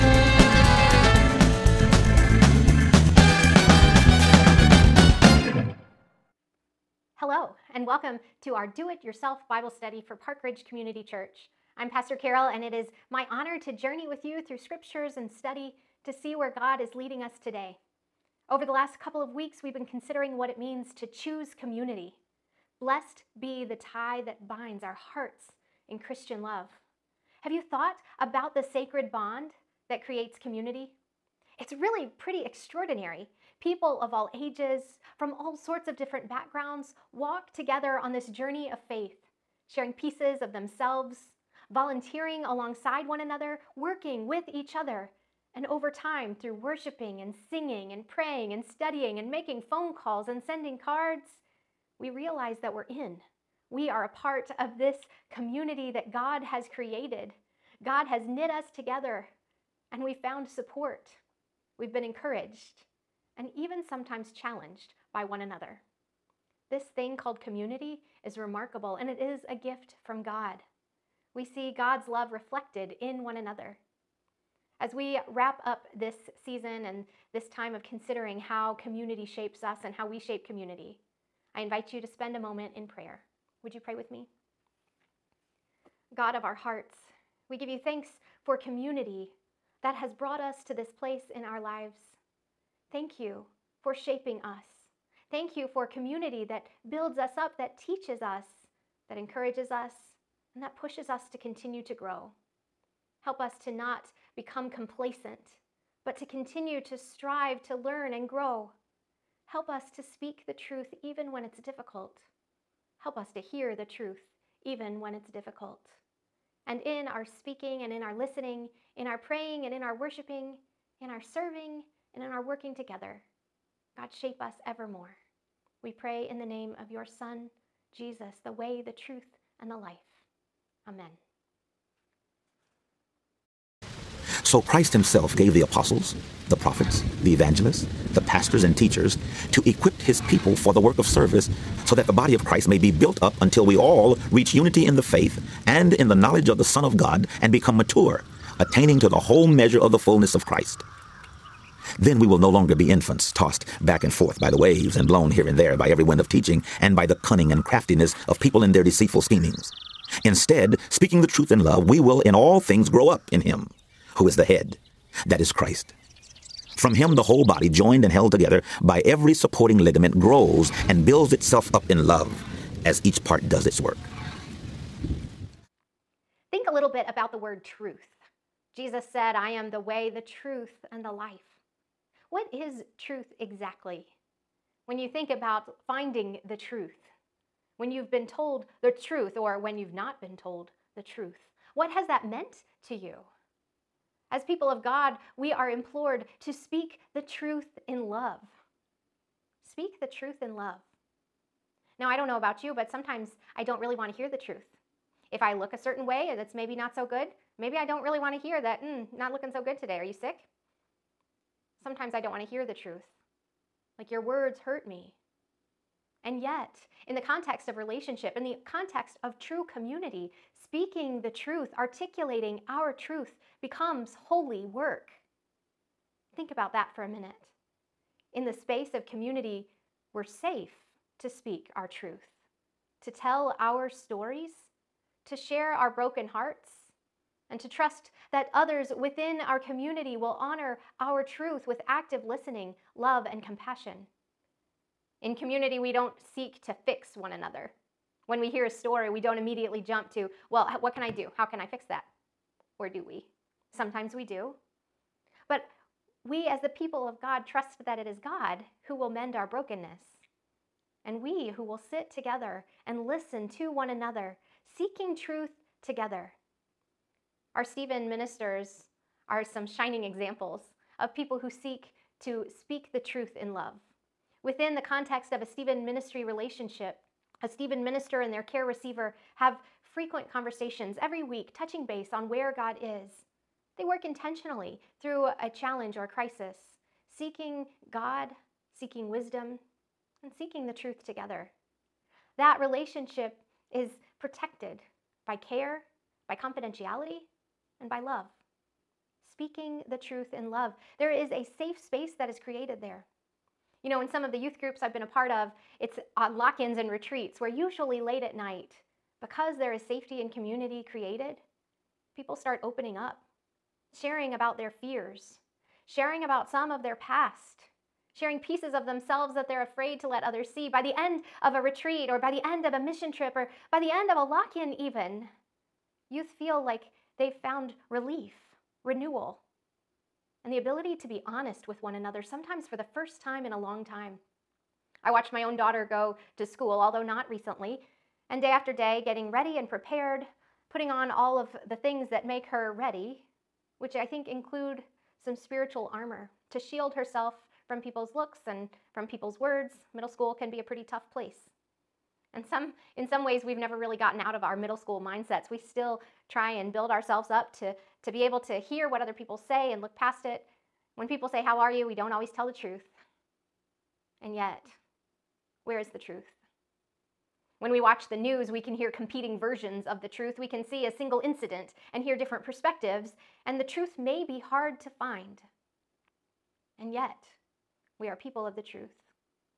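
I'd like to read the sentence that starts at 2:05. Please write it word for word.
We pray in the name of your Son, Jesus, the way, the truth, and the life.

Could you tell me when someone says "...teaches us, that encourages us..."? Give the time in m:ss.
1:37.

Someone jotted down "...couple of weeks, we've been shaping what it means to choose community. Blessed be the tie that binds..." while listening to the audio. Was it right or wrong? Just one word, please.
wrong.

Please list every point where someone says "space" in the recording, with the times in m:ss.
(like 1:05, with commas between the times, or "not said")
3:48, 5:01.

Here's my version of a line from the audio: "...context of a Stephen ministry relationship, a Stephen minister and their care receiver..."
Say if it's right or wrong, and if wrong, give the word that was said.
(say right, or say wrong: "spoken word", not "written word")
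right.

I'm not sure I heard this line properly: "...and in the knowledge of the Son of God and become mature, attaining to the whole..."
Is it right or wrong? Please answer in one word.
right.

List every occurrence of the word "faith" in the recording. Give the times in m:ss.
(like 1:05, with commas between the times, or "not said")
0:38, 2:25.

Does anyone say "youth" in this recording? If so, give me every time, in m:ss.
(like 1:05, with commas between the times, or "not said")
5:04, 5:26.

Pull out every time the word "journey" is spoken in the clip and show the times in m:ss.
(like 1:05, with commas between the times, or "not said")
0:13, 0:38.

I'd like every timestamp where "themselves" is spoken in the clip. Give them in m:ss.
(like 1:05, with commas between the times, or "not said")
0:40, 5:18.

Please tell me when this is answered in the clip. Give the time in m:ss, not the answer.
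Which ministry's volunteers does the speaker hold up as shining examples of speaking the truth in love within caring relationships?
4:27.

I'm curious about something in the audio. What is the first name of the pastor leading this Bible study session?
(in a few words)
Carol.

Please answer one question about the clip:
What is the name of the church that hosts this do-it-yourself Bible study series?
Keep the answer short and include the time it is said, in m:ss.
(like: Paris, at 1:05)
Park Ridge Community Church, at 0:10.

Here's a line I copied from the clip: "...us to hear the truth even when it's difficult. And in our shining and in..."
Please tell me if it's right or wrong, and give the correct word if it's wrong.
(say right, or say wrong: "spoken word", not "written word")
wrong: "speaking", not "shining".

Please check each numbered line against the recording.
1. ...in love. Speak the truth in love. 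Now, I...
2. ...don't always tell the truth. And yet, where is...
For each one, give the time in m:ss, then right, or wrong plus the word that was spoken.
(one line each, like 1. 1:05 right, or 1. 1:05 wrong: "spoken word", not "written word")
1. 3:17 right
2. 6:01 right.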